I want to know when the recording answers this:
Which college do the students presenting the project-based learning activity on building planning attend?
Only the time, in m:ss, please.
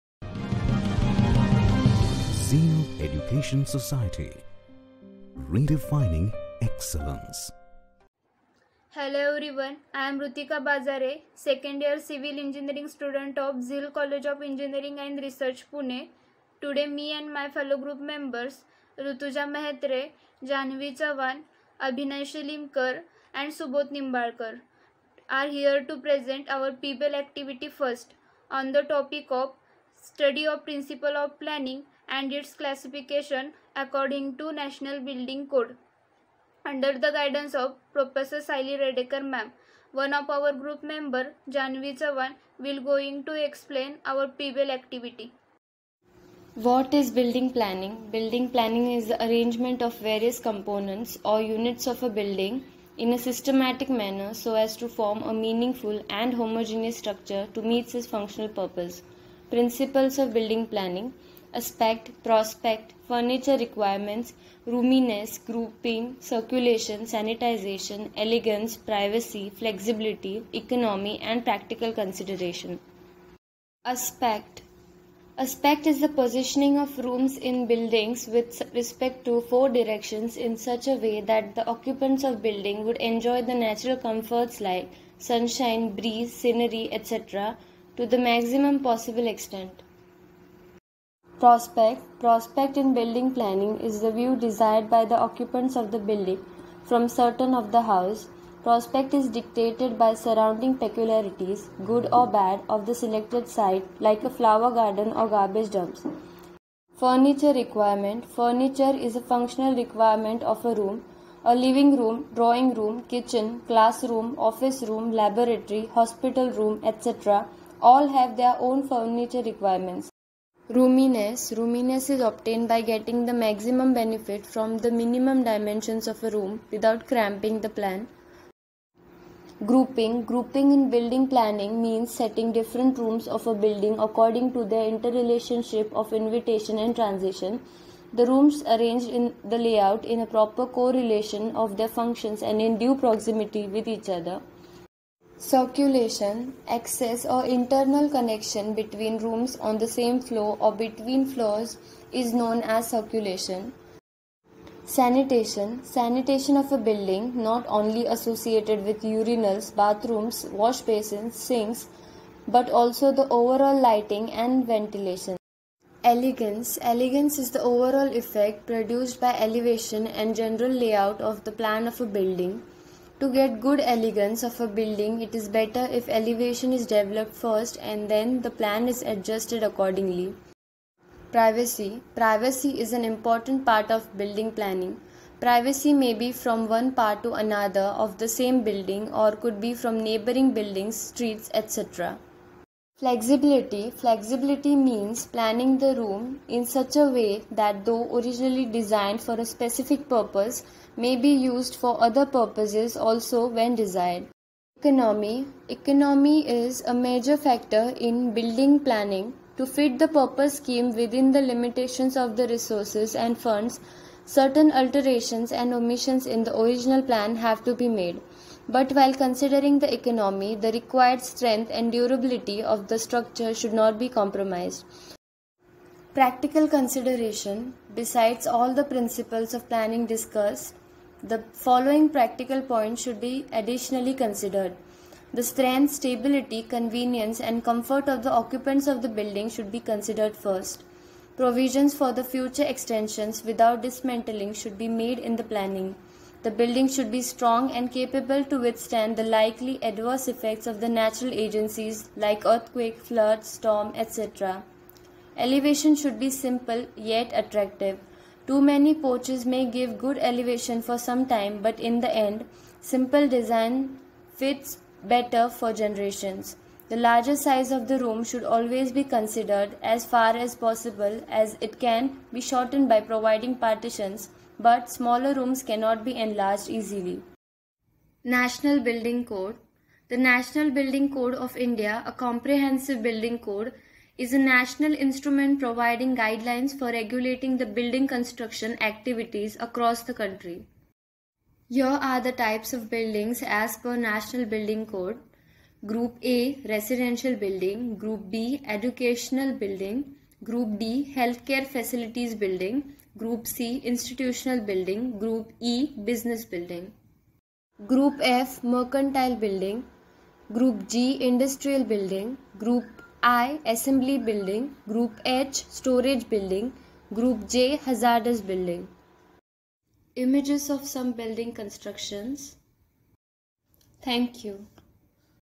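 0:13.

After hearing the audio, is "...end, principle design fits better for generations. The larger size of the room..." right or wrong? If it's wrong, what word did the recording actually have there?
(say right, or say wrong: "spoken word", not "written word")
wrong: "simple", not "principle".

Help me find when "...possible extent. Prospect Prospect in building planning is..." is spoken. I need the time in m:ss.
1:28.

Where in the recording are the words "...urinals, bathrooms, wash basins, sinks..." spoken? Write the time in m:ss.
2:39.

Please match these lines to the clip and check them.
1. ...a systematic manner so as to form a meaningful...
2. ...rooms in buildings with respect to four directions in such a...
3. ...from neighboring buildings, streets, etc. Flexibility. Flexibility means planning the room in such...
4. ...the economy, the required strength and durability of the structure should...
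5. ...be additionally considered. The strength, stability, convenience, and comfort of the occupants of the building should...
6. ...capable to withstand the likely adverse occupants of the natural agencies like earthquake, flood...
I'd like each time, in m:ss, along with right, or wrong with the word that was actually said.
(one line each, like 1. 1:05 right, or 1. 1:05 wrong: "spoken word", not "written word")
1. 0:53 right
2. 1:16 right
3. 3:09 right
4. 3:39 right
5. 3:53 right
6. 4:07 wrong: "effects", not "occupants".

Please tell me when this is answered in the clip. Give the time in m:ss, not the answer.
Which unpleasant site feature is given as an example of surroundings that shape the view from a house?
1:45.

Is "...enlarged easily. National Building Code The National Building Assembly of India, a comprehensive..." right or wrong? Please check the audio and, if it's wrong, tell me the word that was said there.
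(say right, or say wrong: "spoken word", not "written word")
wrong: "Code", not "Assembly".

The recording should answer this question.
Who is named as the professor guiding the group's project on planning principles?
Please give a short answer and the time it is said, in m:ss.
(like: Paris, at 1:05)
Saili Redekar, at 0:38.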